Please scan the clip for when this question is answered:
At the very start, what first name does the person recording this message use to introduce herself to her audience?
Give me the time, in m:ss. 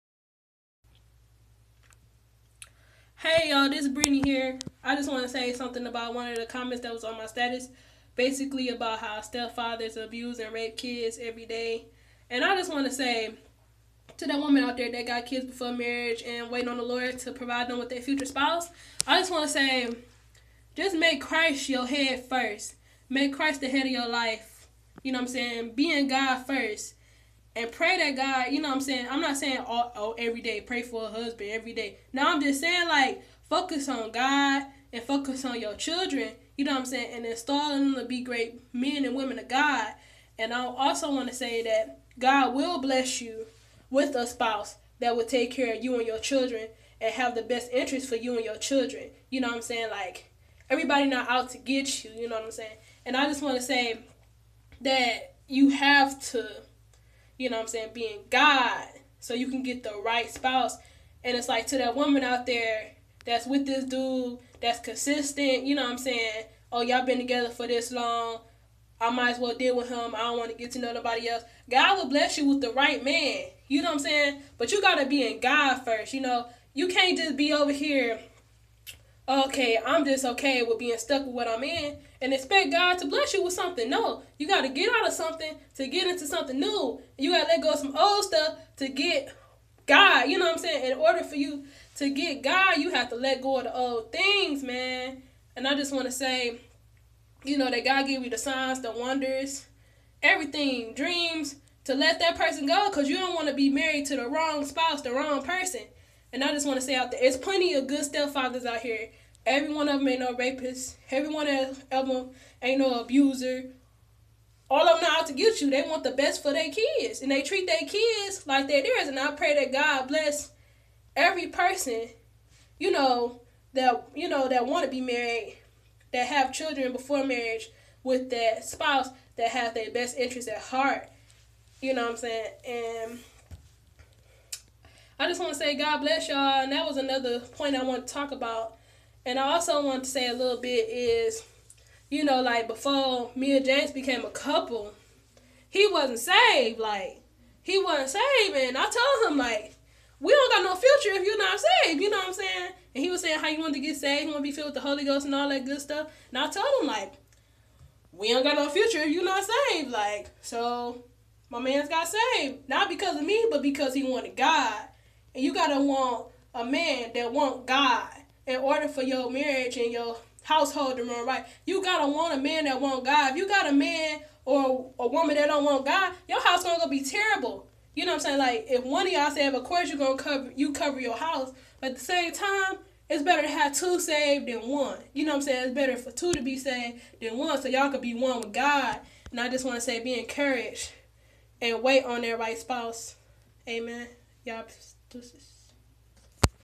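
0:03.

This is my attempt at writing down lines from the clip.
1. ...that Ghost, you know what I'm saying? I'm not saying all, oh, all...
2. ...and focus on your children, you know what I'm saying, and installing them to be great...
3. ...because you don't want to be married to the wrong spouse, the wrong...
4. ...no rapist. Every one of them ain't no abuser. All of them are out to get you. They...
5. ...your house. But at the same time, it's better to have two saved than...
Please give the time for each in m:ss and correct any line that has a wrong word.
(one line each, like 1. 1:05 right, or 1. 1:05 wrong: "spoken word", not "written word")
1. 0:27 wrong: "God", not "Ghost"
2. 0:34 right
3. 1:42 right
4. 1:50 right
5. 3:00 right.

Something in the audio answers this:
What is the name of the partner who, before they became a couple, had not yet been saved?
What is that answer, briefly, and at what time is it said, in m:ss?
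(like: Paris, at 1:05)
James, at 2:23.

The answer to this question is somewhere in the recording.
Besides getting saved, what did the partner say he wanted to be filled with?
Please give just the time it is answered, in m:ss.
2:34.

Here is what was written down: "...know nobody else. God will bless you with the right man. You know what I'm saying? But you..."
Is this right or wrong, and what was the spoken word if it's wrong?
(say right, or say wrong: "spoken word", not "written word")
right.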